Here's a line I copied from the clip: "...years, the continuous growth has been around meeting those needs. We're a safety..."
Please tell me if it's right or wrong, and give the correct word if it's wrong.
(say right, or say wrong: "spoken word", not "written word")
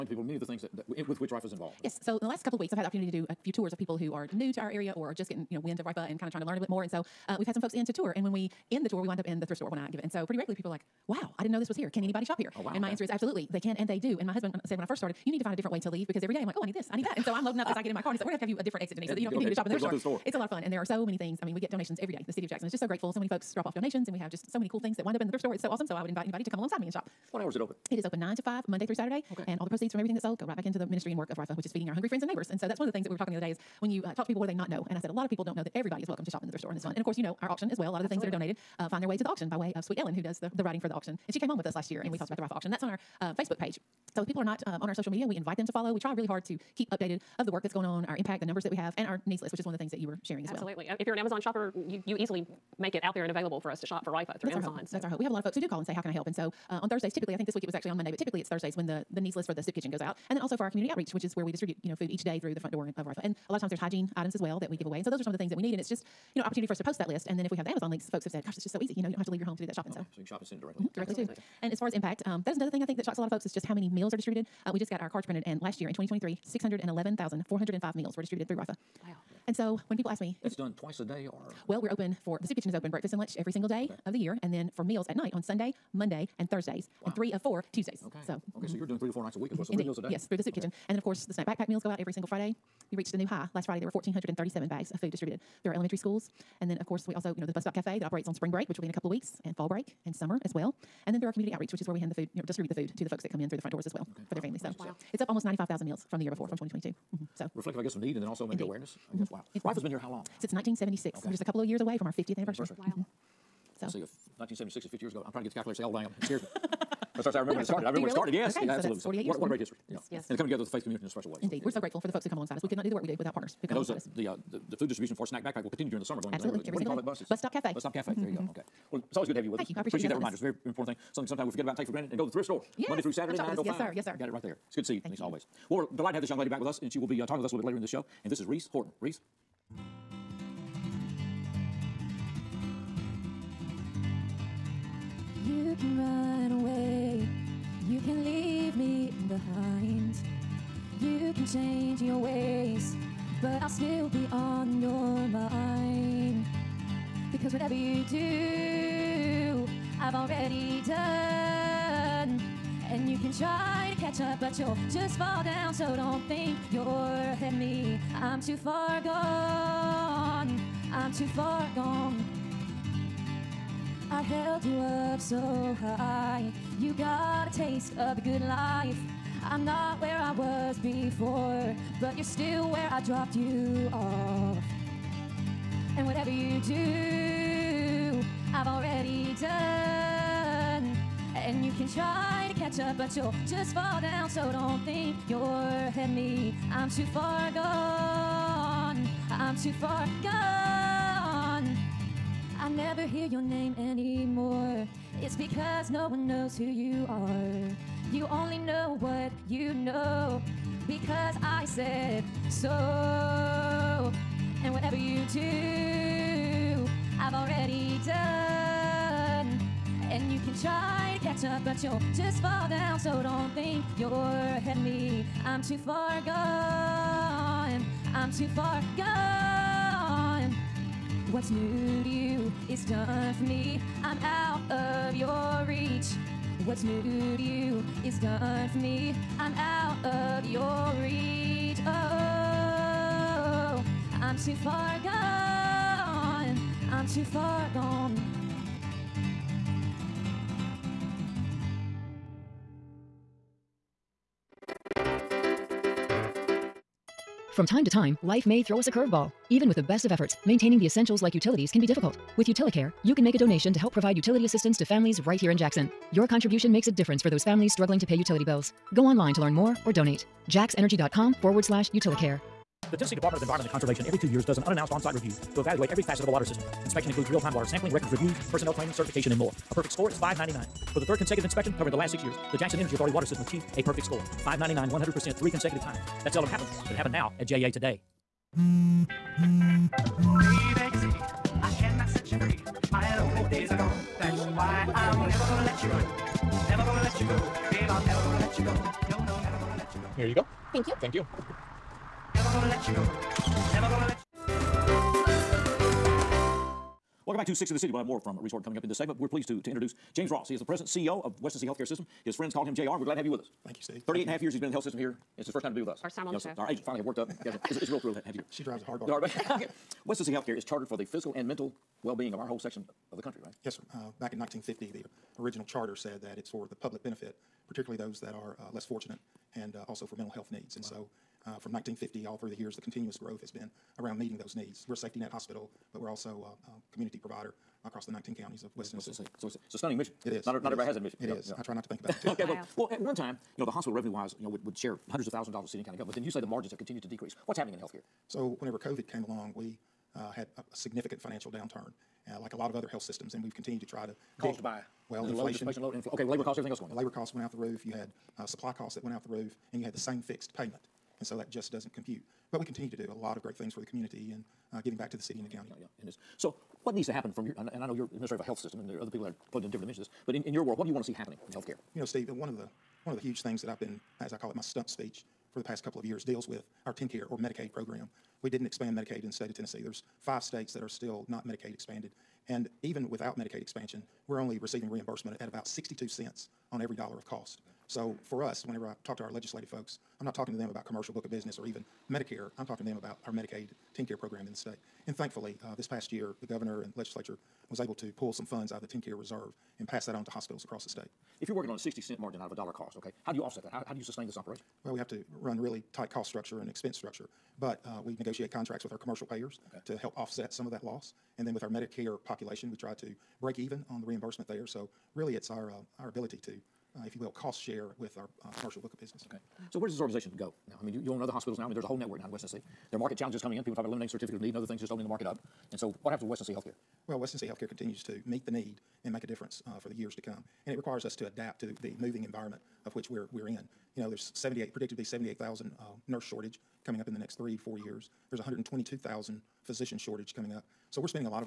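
right.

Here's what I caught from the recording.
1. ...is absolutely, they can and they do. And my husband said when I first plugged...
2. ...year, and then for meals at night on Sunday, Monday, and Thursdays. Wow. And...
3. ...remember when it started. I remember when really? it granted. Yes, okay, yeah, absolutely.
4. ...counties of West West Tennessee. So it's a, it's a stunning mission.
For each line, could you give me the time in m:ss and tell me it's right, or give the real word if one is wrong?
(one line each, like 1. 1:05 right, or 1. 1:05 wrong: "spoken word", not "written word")
1. 0:13 wrong: "started", not "plugged"
2. 1:24 right
3. 1:57 wrong: "started", not "granted"
4. 5:38 right.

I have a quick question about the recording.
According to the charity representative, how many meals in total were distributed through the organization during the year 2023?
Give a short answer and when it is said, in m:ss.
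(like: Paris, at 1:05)
611,405, at 1:16.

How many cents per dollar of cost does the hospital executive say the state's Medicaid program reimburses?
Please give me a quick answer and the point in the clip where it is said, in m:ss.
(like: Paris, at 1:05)
62 cents, at 6:25.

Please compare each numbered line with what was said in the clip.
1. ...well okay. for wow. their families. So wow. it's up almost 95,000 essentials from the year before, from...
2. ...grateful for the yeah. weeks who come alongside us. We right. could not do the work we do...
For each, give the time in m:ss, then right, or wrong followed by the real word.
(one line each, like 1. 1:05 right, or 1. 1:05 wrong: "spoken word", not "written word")
1. 1:43 wrong: "meals", not "essentials"
2. 2:01 wrong: "folks", not "weeks".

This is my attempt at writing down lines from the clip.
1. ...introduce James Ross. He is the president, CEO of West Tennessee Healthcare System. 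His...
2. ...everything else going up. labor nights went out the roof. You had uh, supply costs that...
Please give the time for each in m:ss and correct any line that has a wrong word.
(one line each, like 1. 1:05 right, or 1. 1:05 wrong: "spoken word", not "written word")
1. 5:09 right
2. 5:56 wrong: "costs", not "nights".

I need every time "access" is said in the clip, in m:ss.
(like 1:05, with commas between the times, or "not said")
not said.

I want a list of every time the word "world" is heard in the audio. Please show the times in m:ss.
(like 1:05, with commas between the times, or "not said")
6:10.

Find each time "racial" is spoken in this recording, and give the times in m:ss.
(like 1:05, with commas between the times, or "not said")
not said.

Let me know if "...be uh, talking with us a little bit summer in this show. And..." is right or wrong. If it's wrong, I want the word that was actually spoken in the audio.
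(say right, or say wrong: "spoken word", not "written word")
wrong: "later", not "summer".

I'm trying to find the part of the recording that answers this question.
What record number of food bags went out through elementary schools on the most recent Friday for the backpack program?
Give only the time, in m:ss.
1:33.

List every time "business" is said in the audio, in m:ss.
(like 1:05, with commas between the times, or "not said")
6:31, 6:59.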